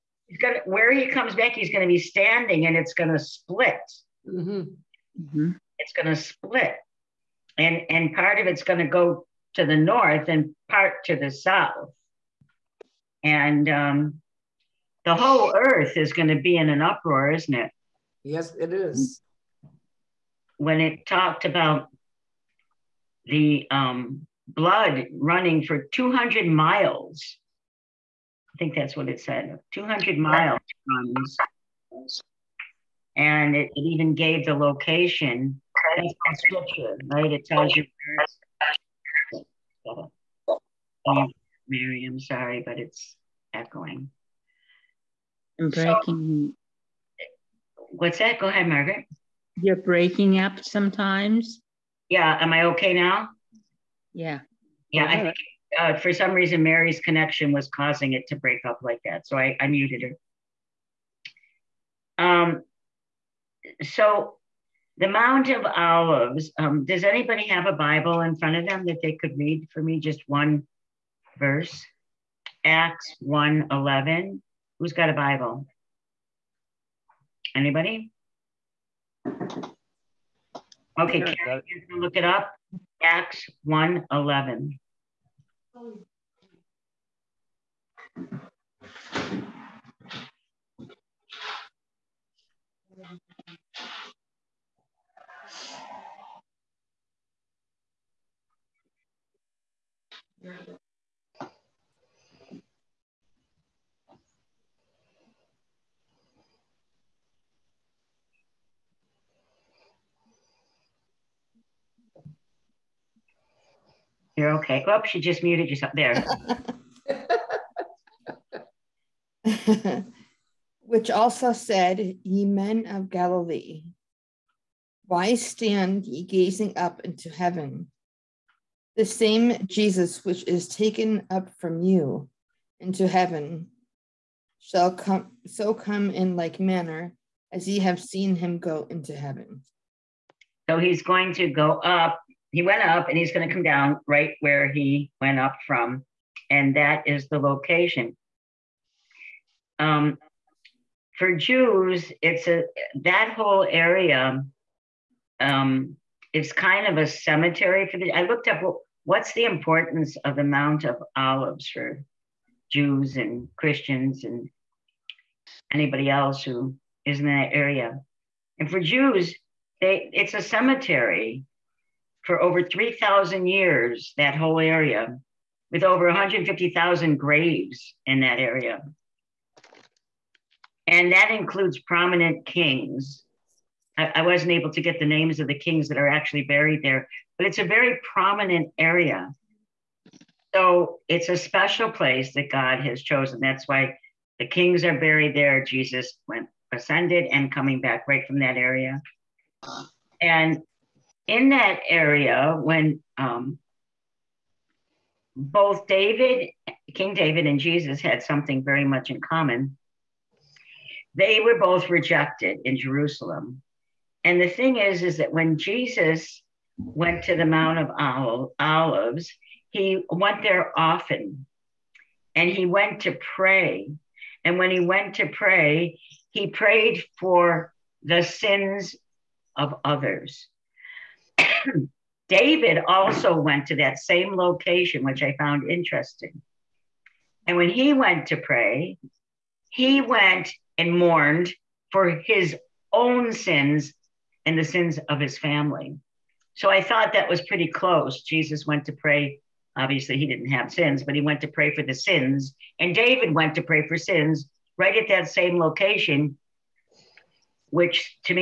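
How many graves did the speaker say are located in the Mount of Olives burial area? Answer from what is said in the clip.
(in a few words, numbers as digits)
Over 150,000.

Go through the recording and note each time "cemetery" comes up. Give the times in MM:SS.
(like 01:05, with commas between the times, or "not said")
02:37, 02:50.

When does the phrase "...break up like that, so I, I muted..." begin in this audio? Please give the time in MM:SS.
00:58.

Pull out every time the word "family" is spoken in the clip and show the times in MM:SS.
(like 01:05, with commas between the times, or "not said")
04:05.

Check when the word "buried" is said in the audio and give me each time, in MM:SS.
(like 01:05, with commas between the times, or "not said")
03:06, 03:14.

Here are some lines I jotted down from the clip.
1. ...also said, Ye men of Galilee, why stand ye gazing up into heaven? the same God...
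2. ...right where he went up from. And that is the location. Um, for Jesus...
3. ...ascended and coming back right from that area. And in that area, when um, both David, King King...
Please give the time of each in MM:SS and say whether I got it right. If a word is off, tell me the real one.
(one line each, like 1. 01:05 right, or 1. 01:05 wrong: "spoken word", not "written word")
1. 02:01 wrong: "Jesus", not "God"
2. 02:24 wrong: "Jews", not "Jesus"
3. 03:16 wrong: "David", not "King".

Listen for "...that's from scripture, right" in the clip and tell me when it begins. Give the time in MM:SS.
00:35.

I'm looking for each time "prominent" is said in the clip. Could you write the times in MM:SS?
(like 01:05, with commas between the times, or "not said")
03:01, 03:08.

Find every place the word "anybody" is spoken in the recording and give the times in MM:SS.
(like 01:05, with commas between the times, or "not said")
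01:07, 01:17, 02:45.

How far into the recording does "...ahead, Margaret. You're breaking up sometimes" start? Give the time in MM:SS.
00:48.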